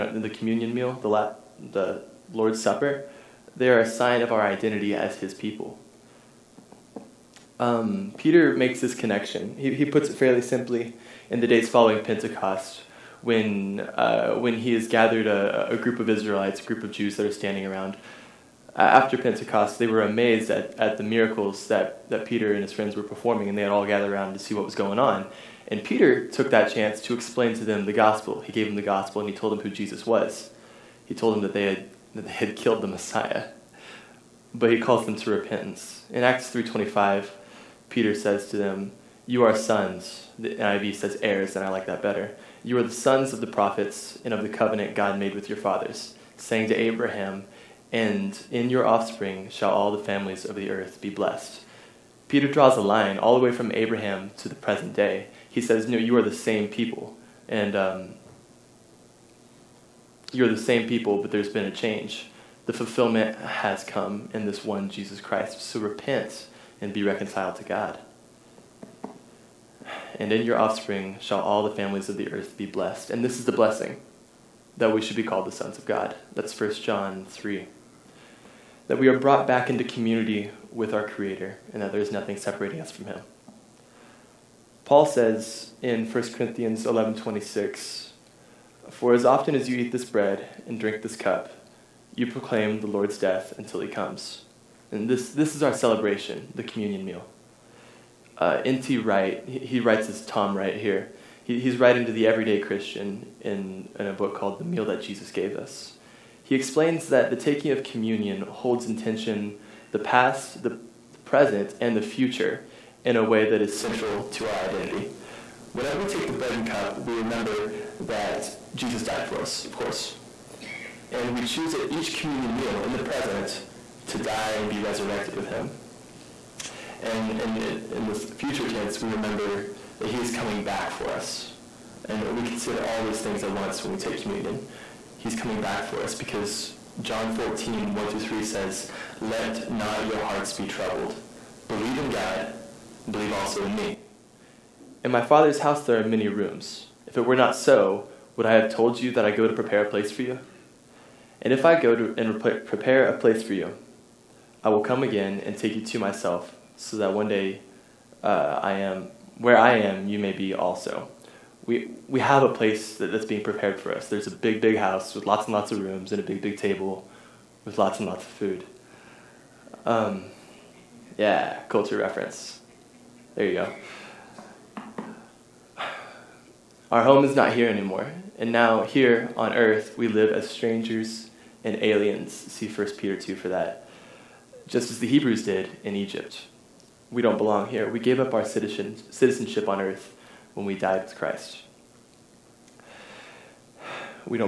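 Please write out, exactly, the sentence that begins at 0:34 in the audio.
But he calls them to repentance.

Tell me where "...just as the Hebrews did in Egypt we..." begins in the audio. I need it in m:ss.
3:04.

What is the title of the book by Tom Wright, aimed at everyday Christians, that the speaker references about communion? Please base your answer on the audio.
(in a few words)
The Meal That Jesus Gave Us.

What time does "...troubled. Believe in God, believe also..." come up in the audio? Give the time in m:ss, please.
2:20.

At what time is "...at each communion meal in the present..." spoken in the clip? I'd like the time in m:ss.
2:01.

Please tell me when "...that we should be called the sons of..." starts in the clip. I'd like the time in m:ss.
1:14.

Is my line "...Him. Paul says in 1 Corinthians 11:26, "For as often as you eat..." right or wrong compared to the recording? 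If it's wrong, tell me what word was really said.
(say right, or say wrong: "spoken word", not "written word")
right.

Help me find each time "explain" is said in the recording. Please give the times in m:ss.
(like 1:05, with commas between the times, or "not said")
0:27, 1:46.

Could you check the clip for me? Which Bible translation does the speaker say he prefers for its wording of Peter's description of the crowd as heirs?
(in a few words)
NIV.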